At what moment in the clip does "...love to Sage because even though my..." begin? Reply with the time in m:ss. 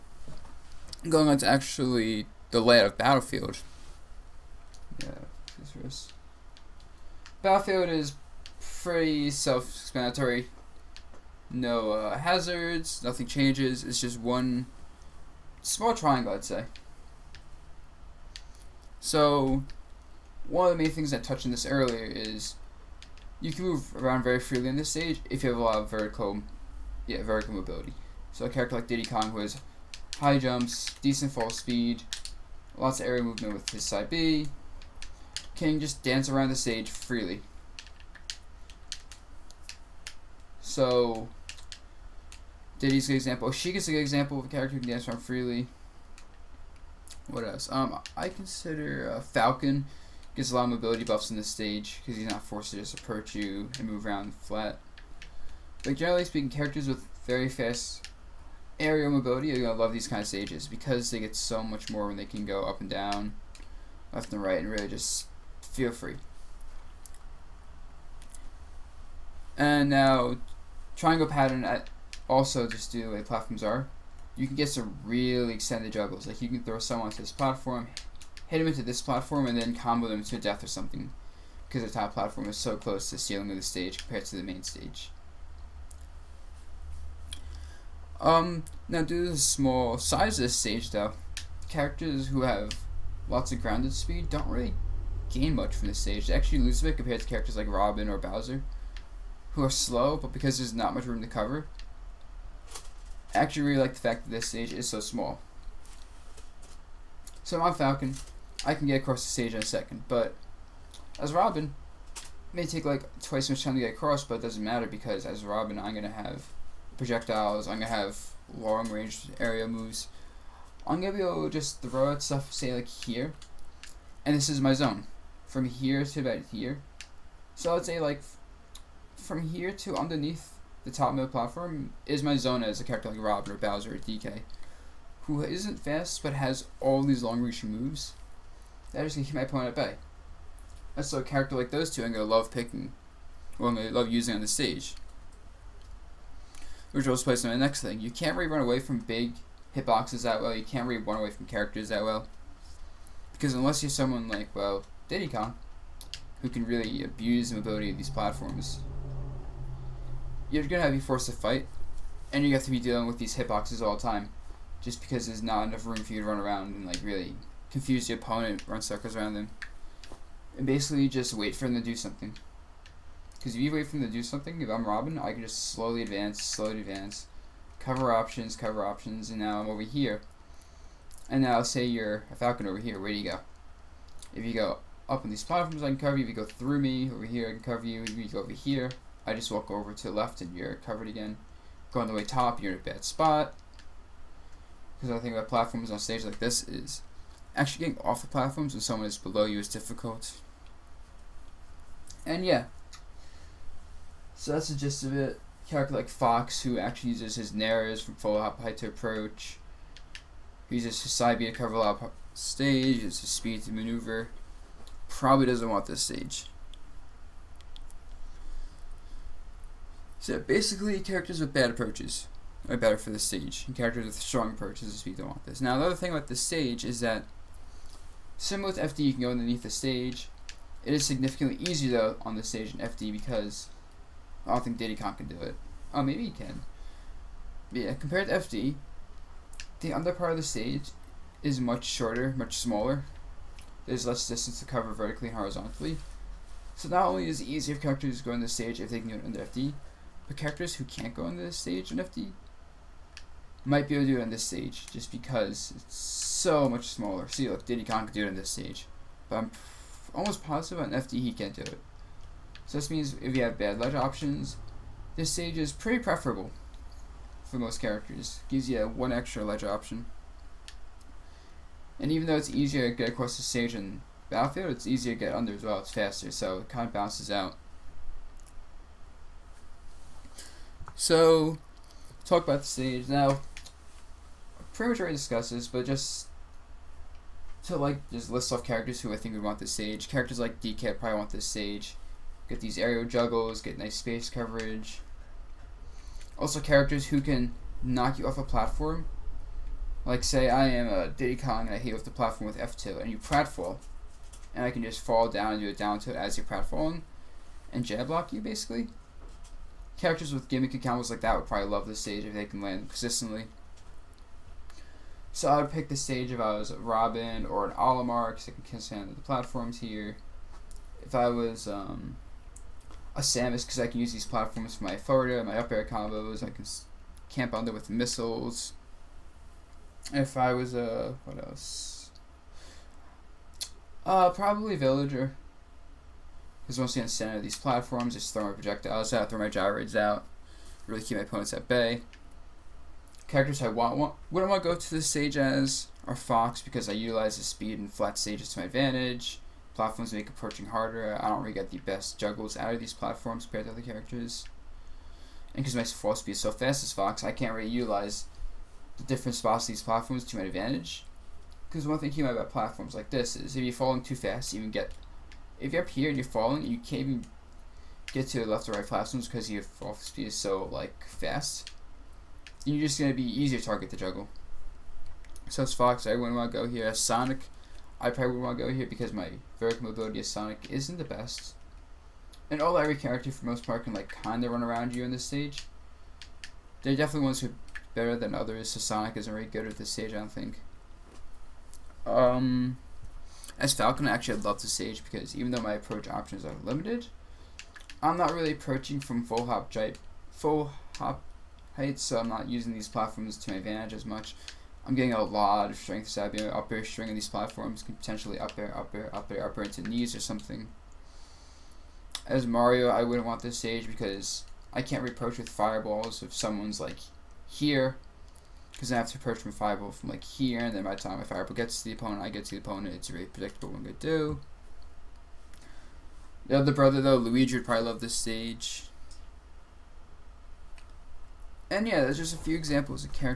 6:34.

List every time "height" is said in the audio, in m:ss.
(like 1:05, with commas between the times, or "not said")
3:28, 6:41.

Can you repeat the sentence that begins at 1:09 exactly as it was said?
And now, triangle pattern at also just do like platforms are, you can get some really extended juggles.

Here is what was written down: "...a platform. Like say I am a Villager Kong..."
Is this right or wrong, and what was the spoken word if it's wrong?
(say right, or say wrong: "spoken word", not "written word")
wrong: "Diddy", not "Villager".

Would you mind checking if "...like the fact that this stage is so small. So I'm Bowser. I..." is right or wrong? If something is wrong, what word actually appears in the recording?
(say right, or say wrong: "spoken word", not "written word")
wrong: "Falcon", not "Bowser".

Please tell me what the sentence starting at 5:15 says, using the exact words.
So I would pick the stage if I was Robin or an Olimar because I can stand the platforms here.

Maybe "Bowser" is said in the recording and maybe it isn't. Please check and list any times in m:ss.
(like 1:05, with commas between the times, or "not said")
1:38, 2:13.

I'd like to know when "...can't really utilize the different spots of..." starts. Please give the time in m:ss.
5:57.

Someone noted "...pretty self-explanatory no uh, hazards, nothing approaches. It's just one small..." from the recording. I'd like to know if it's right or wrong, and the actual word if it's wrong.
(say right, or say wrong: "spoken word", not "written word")
wrong: "changes", not "approaches".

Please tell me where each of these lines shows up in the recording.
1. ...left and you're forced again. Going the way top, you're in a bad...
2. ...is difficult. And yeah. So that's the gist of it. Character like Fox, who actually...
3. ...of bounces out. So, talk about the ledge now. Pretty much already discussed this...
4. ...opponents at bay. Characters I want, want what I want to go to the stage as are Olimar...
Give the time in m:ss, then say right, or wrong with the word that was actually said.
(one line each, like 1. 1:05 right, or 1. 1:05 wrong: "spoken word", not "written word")
1. 3:10 wrong: "covered", not "forced"
2. 3:19 right
3. 4:36 wrong: "stage", not "ledge"
4. 5:41 wrong: "Fox", not "Olimar".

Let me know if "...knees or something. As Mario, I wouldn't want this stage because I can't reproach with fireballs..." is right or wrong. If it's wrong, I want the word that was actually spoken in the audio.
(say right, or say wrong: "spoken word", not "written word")
right.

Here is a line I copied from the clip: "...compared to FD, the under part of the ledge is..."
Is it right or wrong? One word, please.
wrong.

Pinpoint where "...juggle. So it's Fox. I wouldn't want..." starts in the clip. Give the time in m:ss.
6:13.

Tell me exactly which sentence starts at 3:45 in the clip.
Now, the other thing about the stage is that, similar with FD, you can go underneath the stage.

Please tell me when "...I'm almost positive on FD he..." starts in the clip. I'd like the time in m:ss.
4:19.